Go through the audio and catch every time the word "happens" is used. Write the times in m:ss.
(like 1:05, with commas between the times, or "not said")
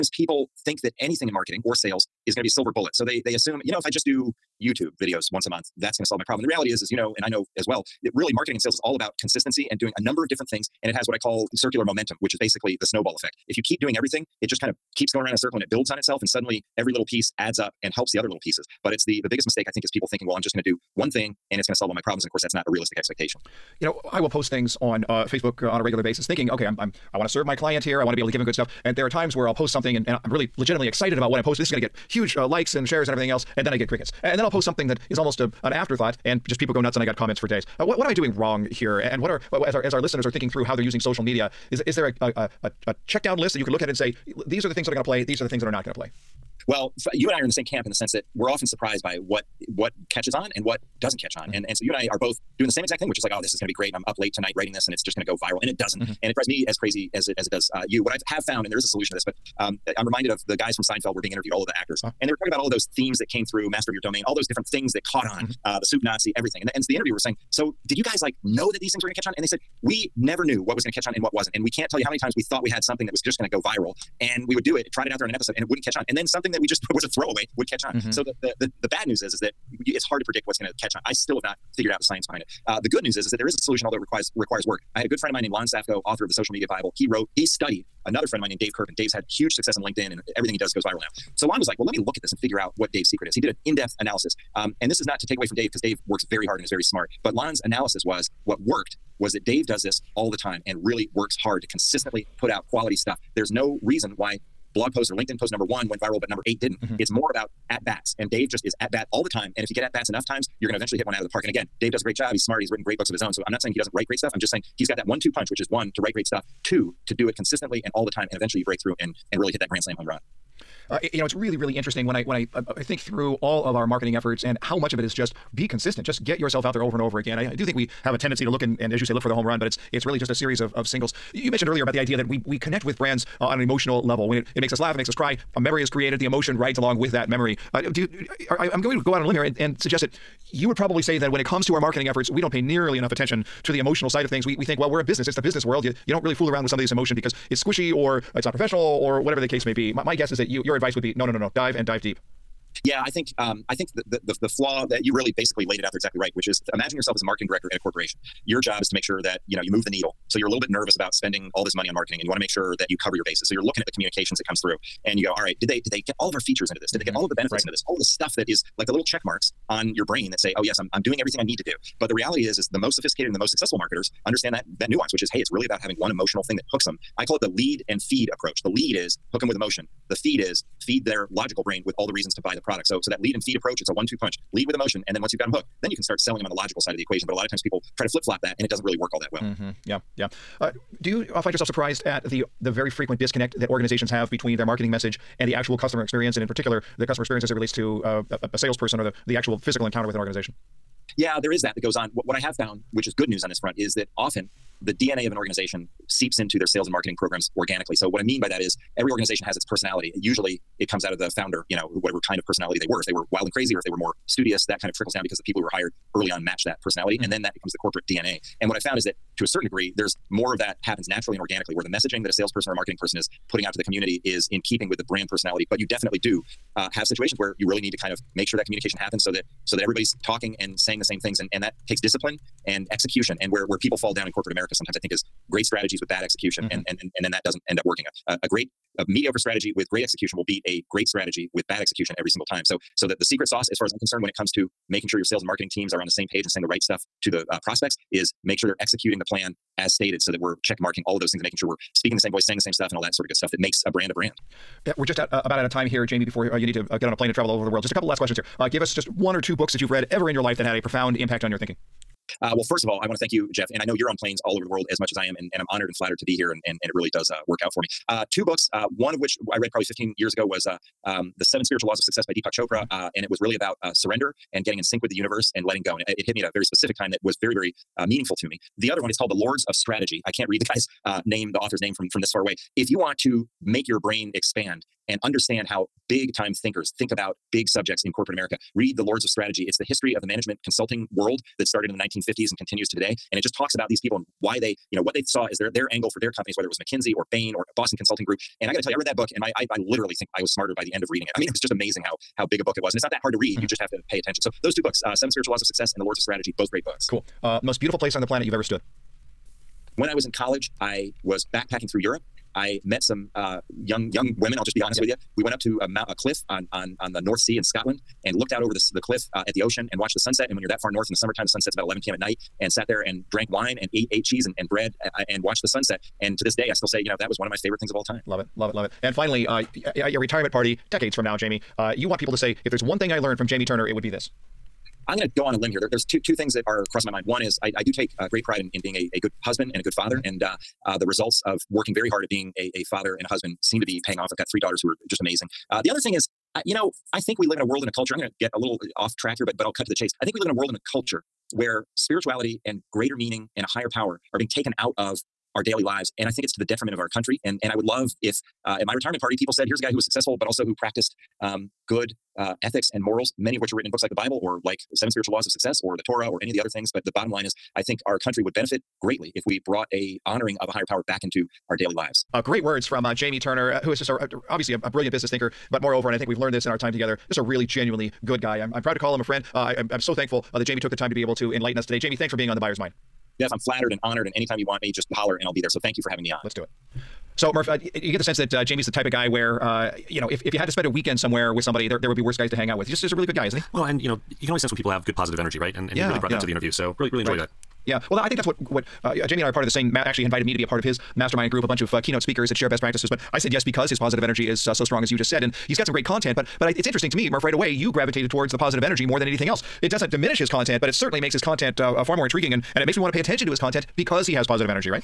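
3:40, 3:48.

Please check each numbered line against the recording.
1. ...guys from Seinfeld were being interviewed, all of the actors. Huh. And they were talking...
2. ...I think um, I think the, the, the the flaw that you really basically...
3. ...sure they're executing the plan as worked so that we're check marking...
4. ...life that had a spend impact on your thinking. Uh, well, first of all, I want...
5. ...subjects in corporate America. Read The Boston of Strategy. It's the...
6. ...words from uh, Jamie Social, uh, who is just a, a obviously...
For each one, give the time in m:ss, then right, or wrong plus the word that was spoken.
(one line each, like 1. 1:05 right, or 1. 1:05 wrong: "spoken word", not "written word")
1. 1:00 right
2. 2:33 right
3. 4:08 wrong: "stated", not "worked"
4. 4:20 wrong: "profound", not "spend"
5. 4:47 wrong: "Lords", not "Boston"
6. 6:12 wrong: "Turner", not "Social".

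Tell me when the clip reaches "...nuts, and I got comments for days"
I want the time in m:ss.
0:36.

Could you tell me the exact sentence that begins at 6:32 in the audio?
He just is a really good guy, isn't he?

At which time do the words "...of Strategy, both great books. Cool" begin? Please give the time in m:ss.
5:06.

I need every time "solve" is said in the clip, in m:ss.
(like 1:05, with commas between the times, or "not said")
0:06, 0:21.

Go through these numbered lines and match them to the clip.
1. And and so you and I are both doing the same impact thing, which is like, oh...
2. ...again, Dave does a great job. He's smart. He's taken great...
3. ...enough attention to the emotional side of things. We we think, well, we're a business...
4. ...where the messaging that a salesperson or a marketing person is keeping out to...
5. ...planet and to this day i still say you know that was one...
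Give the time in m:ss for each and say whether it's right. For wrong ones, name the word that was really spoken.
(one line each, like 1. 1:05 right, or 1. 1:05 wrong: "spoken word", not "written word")
1. 0:51 wrong: "exact", not "impact"
2. 1:51 wrong: "written", not "taken"
3. 2:22 right
4. 3:41 wrong: "putting", not "keeping"
5. 5:25 wrong: "sunset", not "planet".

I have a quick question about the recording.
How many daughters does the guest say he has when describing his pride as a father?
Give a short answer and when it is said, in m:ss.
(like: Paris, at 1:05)
3, at 5:44.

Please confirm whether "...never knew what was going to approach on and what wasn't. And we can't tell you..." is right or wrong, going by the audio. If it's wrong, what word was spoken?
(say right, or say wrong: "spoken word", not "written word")
wrong: "catch", not "approach".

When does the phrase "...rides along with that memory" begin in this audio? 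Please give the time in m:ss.
2:16.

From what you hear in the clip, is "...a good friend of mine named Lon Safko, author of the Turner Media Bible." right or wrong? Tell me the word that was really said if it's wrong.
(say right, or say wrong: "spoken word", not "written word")
wrong: "Social", not "Turner".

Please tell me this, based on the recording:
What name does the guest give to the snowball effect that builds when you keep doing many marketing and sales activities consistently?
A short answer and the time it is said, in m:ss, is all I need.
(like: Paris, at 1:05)
Circular momentum, at 0:11.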